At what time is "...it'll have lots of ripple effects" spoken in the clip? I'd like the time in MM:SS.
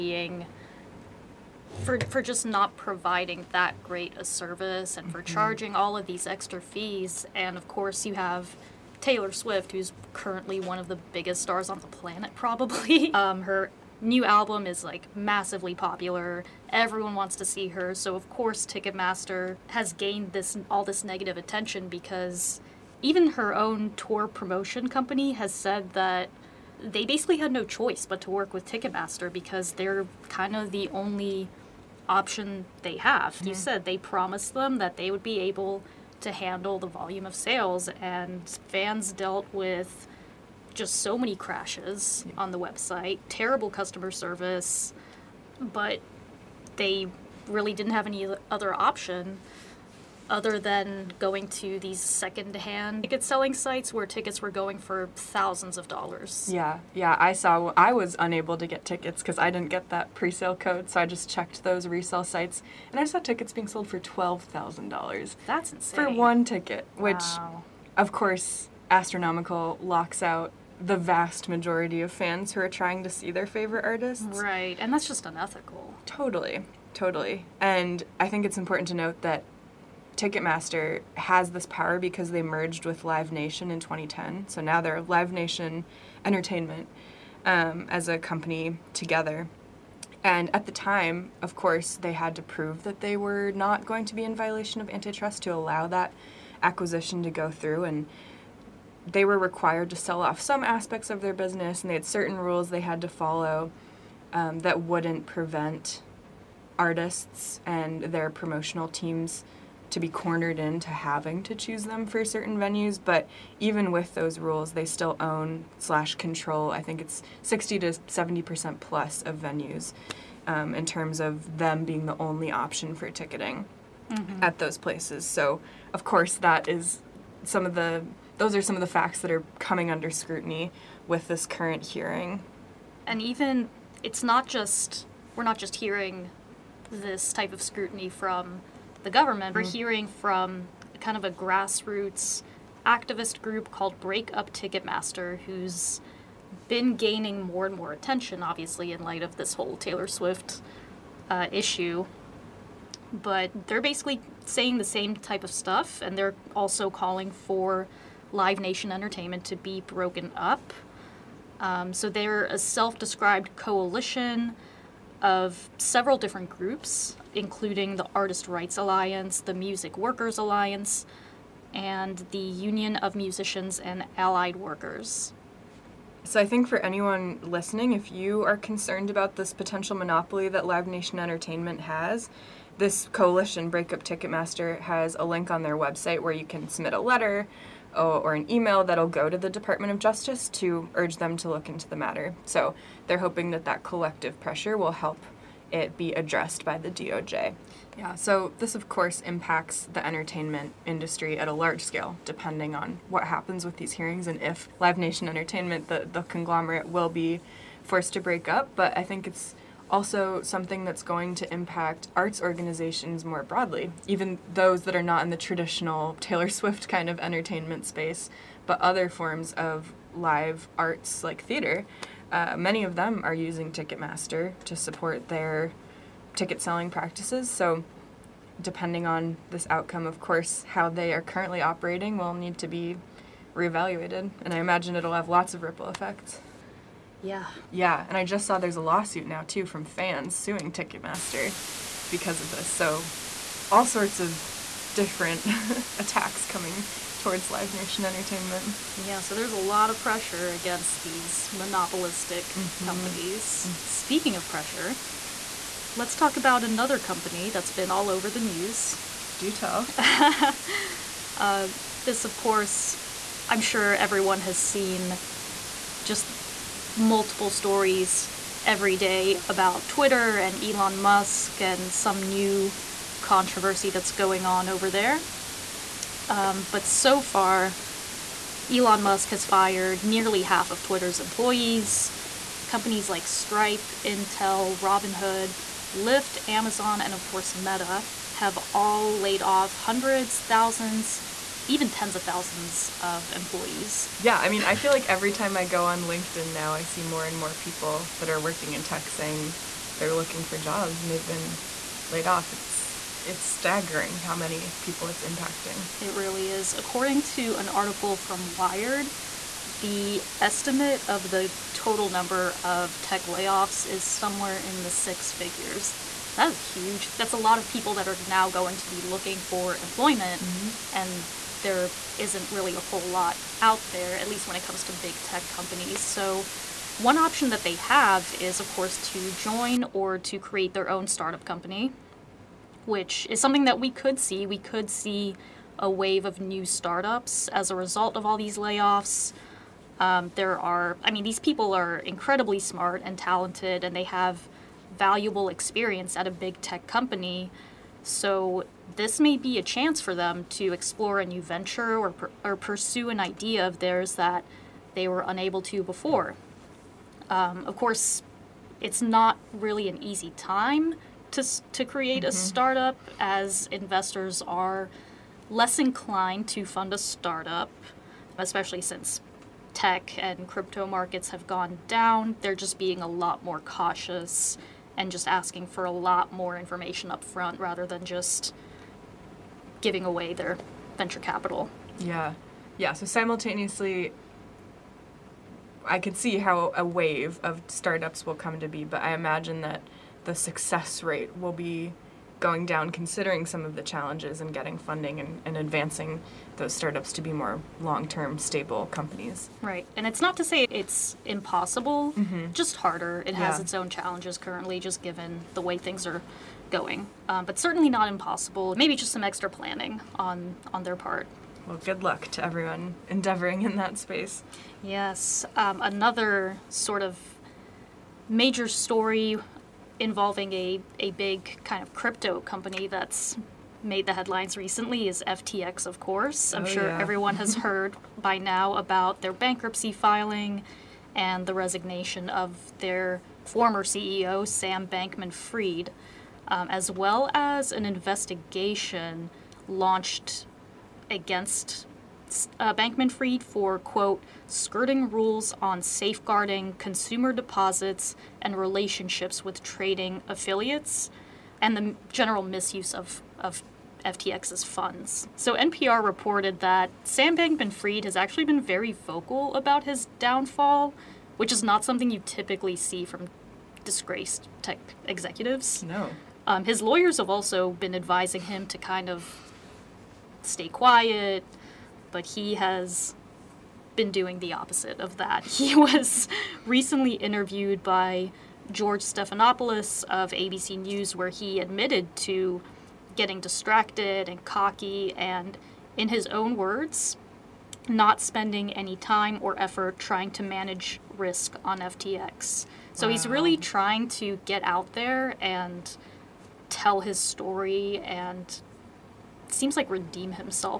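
03:54.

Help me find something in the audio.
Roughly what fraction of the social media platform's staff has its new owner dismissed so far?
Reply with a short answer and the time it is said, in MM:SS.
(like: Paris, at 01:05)
Nearly half, at 04:40.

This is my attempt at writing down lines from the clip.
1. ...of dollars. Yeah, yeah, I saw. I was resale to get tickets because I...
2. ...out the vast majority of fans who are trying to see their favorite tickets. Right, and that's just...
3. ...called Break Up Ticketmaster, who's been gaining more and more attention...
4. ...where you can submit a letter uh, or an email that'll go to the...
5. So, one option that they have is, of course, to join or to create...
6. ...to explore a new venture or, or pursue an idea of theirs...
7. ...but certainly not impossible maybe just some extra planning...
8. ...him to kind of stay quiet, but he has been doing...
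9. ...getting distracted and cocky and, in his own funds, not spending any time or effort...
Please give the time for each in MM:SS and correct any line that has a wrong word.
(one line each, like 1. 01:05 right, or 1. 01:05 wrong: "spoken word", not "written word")
1. 00:55 wrong: "unable", not "resale"
2. 01:10 wrong: "artists", not "tickets"
3. 02:23 right
4. 03:06 right
5. 05:26 right
6. 05:50 right
7. 06:47 right
8. 07:48 right
9. 08:03 wrong: "words", not "funds".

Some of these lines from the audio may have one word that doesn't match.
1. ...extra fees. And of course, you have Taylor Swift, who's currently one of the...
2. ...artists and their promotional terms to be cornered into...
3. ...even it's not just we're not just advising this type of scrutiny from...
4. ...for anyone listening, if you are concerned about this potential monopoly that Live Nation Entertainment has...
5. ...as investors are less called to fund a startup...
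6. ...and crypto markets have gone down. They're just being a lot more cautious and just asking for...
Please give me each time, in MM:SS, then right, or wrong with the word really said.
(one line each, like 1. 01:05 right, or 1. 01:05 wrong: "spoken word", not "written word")
1. 00:06 right
2. 01:46 wrong: "teams", not "terms"
3. 02:13 wrong: "hearing", not "advising"
4. 02:56 right
5. 06:03 wrong: "inclined", not "called"
6. 06:10 right.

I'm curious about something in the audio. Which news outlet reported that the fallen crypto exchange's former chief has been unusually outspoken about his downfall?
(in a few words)
NPR.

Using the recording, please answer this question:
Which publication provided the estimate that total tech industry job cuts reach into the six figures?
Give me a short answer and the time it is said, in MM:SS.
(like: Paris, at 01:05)
Wired, at 05:08.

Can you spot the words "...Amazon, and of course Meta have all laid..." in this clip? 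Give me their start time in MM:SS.
04:46.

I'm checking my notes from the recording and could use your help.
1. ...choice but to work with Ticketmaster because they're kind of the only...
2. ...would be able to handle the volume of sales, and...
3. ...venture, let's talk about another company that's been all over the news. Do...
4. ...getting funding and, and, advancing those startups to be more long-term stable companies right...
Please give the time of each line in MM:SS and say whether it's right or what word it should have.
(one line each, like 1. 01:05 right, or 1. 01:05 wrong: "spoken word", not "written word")
1. 00:27 right
2. 00:35 right
3. 04:14 wrong: "pressure", not "venture"
4. 06:34 right.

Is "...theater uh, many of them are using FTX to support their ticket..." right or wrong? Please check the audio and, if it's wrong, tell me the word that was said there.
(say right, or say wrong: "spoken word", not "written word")
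wrong: "Ticketmaster", not "FTX".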